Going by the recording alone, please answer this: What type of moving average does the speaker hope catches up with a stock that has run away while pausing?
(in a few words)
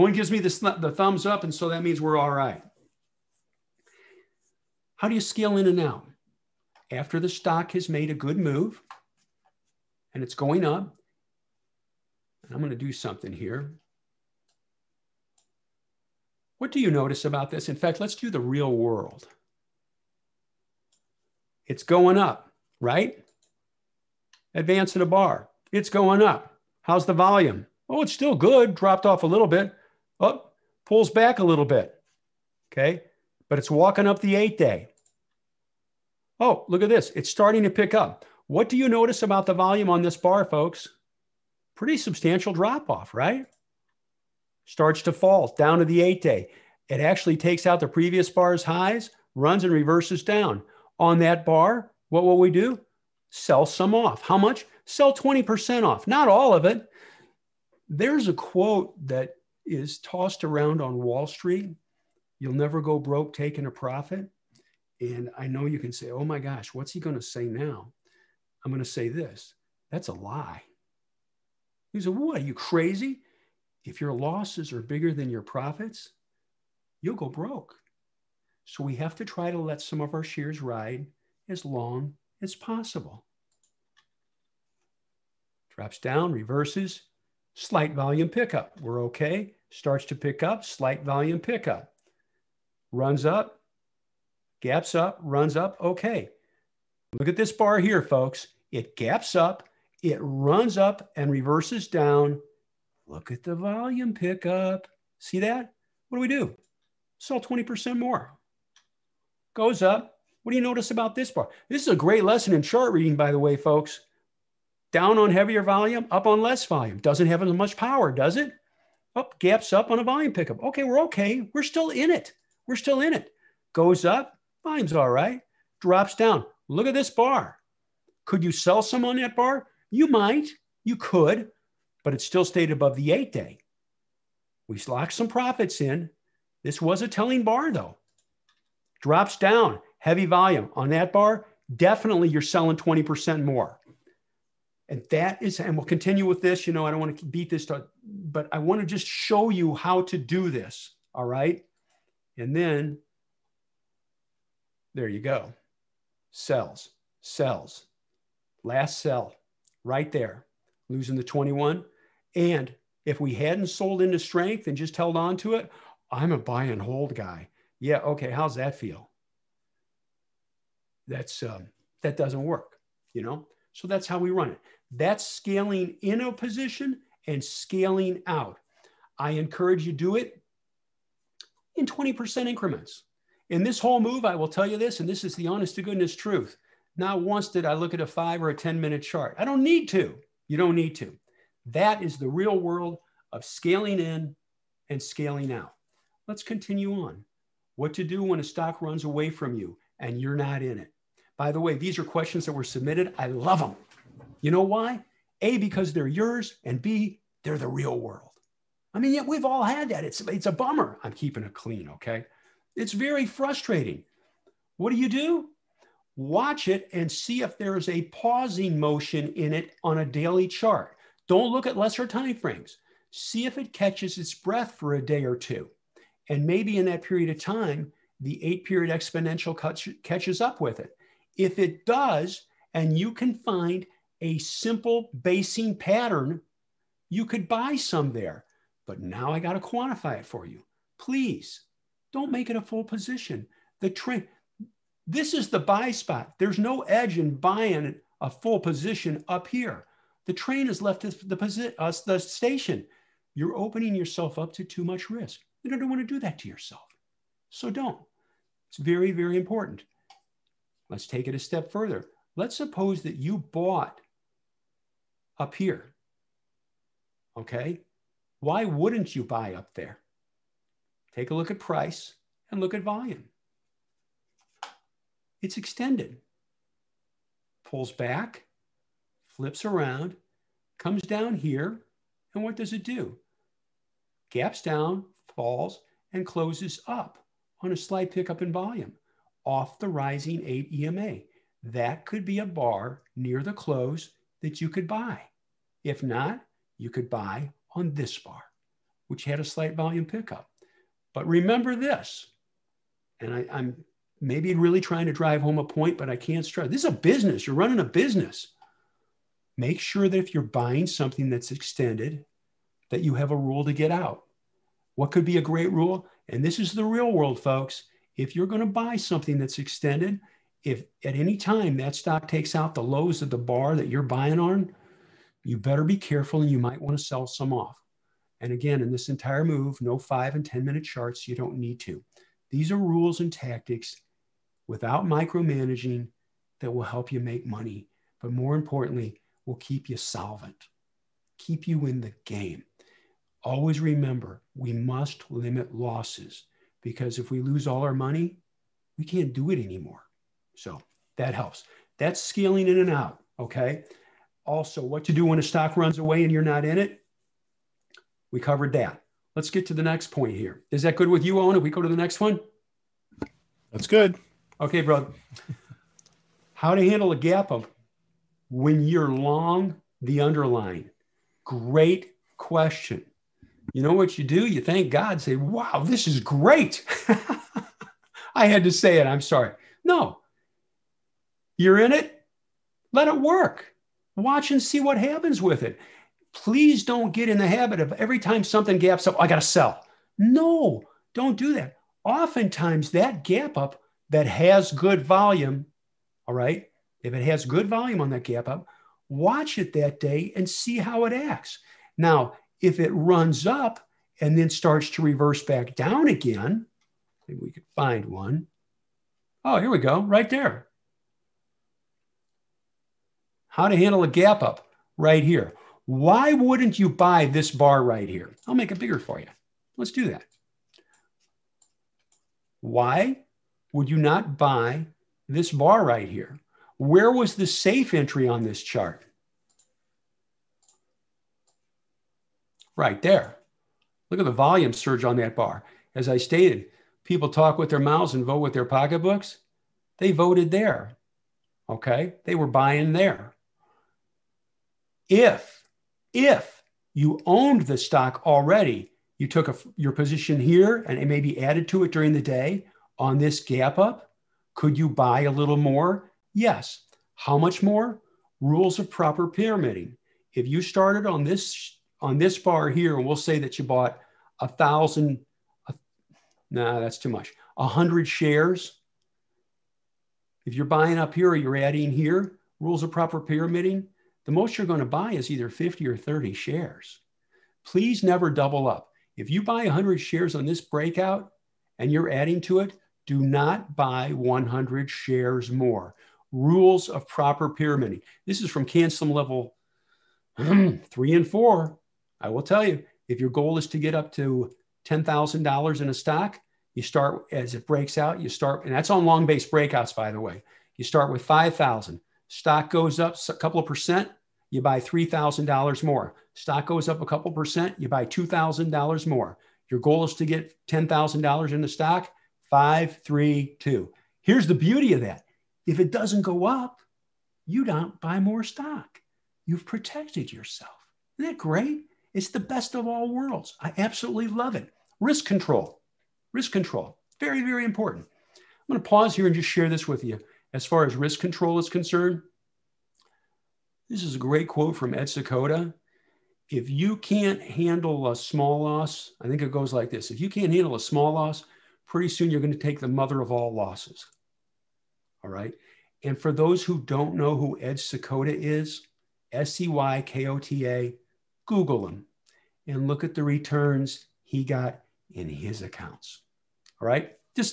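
eight period exponential.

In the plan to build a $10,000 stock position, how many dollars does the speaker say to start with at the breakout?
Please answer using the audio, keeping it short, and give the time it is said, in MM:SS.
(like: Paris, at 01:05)
$5,000, at 08:20.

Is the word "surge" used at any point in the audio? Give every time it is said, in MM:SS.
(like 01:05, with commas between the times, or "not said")
07:14.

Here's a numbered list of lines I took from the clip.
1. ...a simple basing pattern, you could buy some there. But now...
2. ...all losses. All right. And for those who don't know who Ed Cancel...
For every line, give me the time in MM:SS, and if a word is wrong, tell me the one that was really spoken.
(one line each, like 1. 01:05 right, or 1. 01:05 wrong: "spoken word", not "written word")
1. 03:54 right
2. 09:03 wrong: "Seykota", not "Cancel".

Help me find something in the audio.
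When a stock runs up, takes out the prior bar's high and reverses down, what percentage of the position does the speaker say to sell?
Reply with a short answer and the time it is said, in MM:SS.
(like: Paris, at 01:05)
20%, at 00:54.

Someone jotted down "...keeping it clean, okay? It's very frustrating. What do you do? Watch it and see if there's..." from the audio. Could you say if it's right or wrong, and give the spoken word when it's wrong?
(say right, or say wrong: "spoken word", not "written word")
right.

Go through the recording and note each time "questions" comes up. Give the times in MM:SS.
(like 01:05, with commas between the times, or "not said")
03:22, 06:12.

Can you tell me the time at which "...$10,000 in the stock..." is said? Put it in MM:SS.
08:30.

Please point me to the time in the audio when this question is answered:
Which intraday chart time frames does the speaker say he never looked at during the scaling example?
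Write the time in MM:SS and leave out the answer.
03:08.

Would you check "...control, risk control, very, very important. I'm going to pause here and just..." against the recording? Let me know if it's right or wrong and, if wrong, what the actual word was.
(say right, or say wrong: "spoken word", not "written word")
right.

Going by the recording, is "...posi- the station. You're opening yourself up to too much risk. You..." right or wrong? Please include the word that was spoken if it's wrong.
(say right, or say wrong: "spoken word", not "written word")
right.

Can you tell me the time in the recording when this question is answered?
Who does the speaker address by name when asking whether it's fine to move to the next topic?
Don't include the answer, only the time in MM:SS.
06:01.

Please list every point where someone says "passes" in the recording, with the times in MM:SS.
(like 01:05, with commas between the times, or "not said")
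not said.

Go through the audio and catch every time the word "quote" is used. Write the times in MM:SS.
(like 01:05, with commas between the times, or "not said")
00:58, 08:54.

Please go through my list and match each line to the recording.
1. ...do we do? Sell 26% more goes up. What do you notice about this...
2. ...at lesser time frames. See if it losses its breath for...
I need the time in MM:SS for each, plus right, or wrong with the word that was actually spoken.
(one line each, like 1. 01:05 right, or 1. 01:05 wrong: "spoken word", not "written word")
1. 01:46 wrong: "20", not "26"
2. 03:41 wrong: "catches", not "losses".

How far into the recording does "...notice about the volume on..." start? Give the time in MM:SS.
00:38.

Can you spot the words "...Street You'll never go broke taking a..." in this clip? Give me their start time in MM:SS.
01:01.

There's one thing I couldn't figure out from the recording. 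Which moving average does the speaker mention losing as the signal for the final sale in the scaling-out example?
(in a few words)
the 21.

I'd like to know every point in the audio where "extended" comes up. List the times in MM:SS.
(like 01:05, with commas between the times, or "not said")
04:35, 05:11, 05:19.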